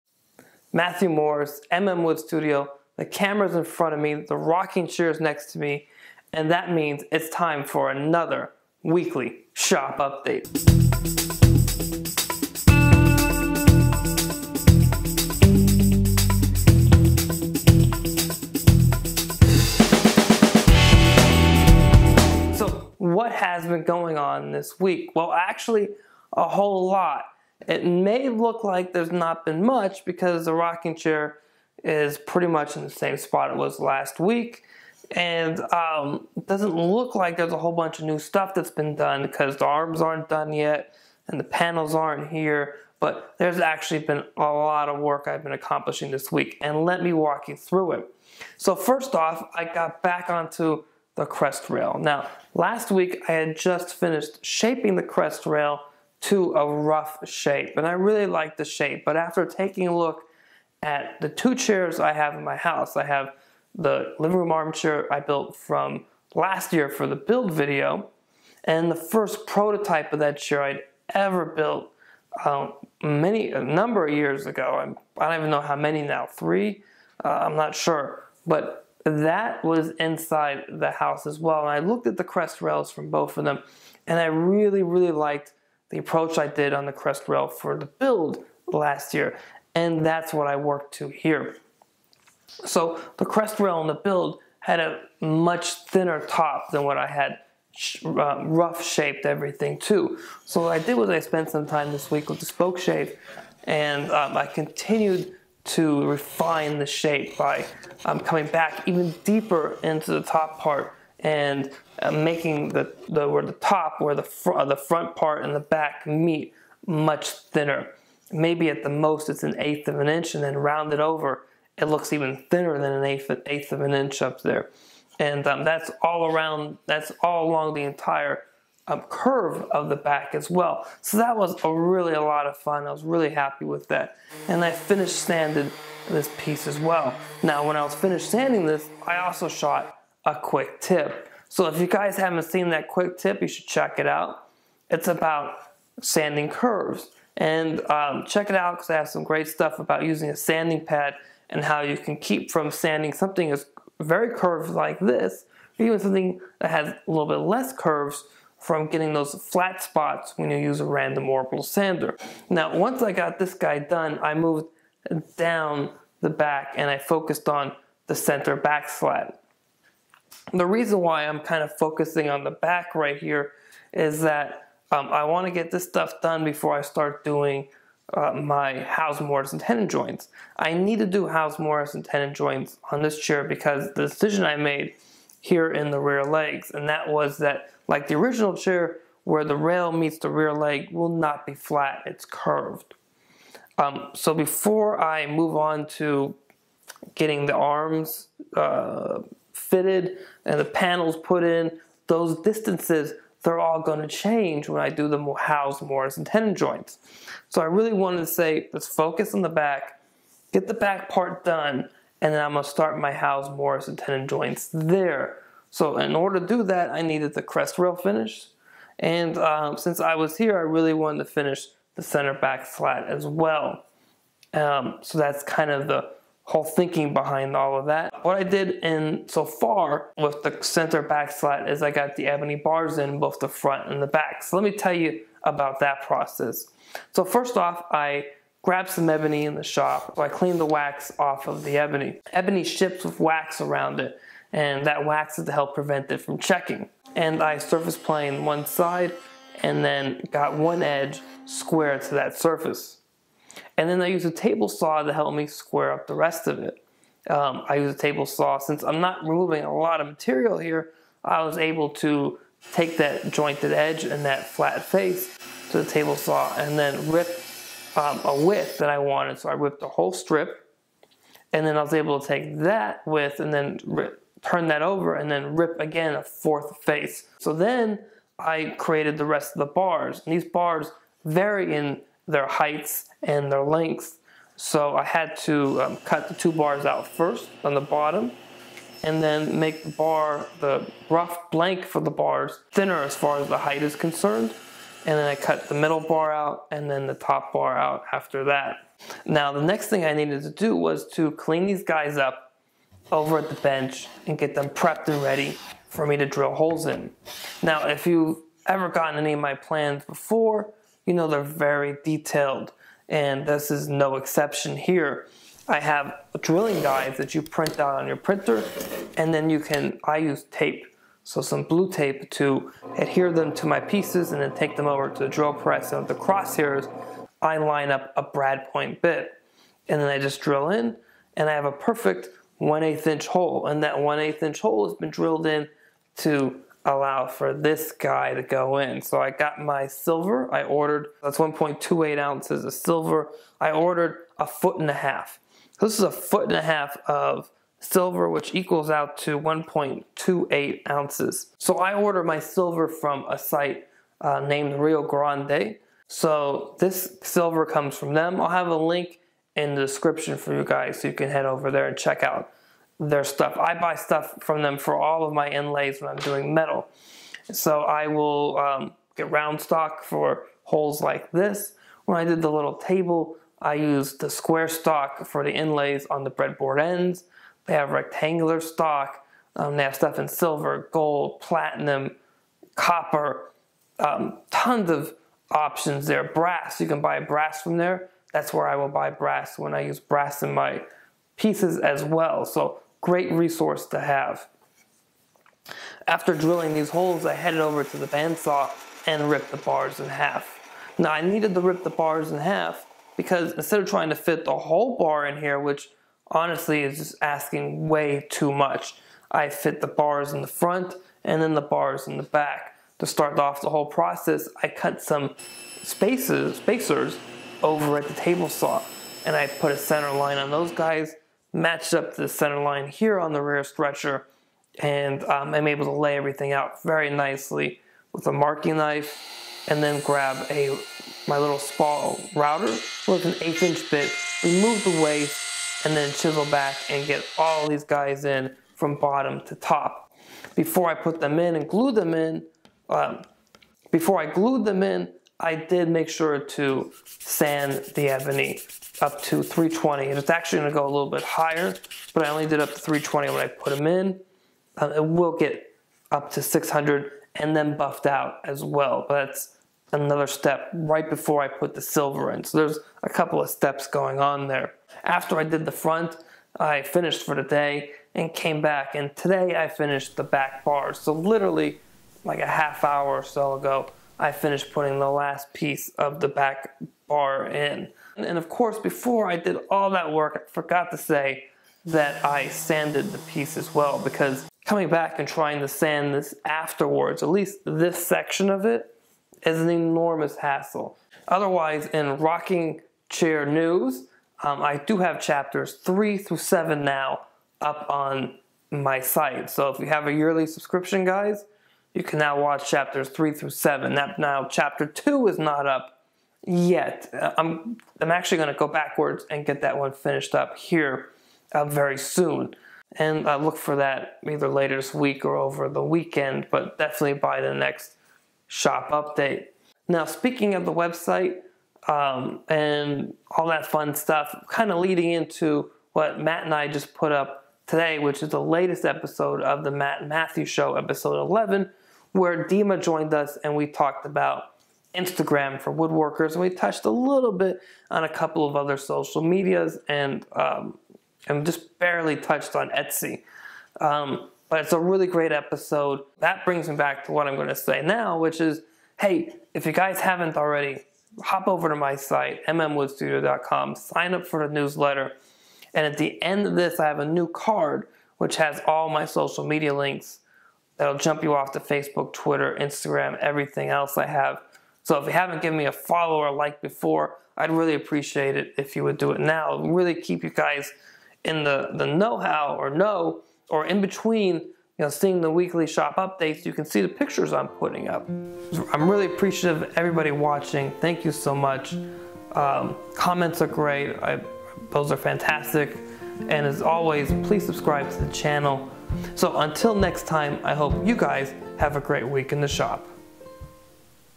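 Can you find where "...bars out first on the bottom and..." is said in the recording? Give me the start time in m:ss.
4:46.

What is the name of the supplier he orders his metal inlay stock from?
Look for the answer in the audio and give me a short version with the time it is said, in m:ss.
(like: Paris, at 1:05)
Rio Grande, at 5:54.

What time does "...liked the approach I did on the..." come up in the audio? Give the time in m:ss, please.
1:25.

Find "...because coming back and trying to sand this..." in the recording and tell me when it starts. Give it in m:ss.
8:04.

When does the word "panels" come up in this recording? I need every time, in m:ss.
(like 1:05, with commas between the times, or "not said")
0:41, 3:20.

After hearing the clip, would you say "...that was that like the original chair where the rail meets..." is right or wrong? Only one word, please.
right.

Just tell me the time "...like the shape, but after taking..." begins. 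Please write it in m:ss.
0:58.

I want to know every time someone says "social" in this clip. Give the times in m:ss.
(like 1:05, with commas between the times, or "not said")
8:58, 9:19.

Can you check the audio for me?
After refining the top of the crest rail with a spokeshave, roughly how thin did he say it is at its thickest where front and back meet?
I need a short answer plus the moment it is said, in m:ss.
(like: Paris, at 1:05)
an eighth of an inch, at 1:59.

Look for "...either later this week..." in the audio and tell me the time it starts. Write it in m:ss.
8:34.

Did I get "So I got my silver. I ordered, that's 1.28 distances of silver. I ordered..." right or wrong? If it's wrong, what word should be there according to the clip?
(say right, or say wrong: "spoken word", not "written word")
wrong: "ounces", not "distances".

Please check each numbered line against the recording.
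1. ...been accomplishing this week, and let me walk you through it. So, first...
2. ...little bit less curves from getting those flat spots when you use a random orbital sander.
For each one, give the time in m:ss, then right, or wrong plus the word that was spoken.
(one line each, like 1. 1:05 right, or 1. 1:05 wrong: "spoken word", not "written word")
1. 0:45 right
2. 2:37 right.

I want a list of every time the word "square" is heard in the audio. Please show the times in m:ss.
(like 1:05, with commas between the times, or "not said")
4:11, 4:15, 6:14.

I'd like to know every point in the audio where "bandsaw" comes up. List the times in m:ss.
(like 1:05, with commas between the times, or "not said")
6:38.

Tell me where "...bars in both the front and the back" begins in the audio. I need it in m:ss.
3:52.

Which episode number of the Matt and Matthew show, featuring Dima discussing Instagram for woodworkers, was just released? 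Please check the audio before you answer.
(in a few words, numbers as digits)
11.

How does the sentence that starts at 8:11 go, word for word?
Otherwise, in rocking chair news, um, I do have chapters three through seven now up on my site.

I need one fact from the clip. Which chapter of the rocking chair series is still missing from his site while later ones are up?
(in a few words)
chapter 2.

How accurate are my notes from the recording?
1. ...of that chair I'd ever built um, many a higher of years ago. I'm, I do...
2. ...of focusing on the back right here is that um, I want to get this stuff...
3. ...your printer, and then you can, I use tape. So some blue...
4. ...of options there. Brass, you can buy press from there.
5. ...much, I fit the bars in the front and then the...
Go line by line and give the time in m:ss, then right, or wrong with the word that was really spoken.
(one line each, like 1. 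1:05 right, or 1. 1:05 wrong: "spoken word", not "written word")
1. 1:10 wrong: "number", not "higher"
2. 2:51 right
3. 5:18 right
4. 6:24 wrong: "brass", not "press"
5. 6:48 right.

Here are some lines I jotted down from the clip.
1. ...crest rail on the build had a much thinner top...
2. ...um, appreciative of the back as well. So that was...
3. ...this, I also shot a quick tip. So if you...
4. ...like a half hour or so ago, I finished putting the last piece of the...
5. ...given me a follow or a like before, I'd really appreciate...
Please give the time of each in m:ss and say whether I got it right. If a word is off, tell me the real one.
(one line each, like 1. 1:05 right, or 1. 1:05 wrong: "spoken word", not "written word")
1. 1:33 right
2. 2:08 wrong: "curve", not "appreciative"
3. 2:18 right
4. 7:52 right
5. 9:25 right.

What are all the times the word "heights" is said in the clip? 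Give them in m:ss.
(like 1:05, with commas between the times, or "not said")
4:42, 4:53.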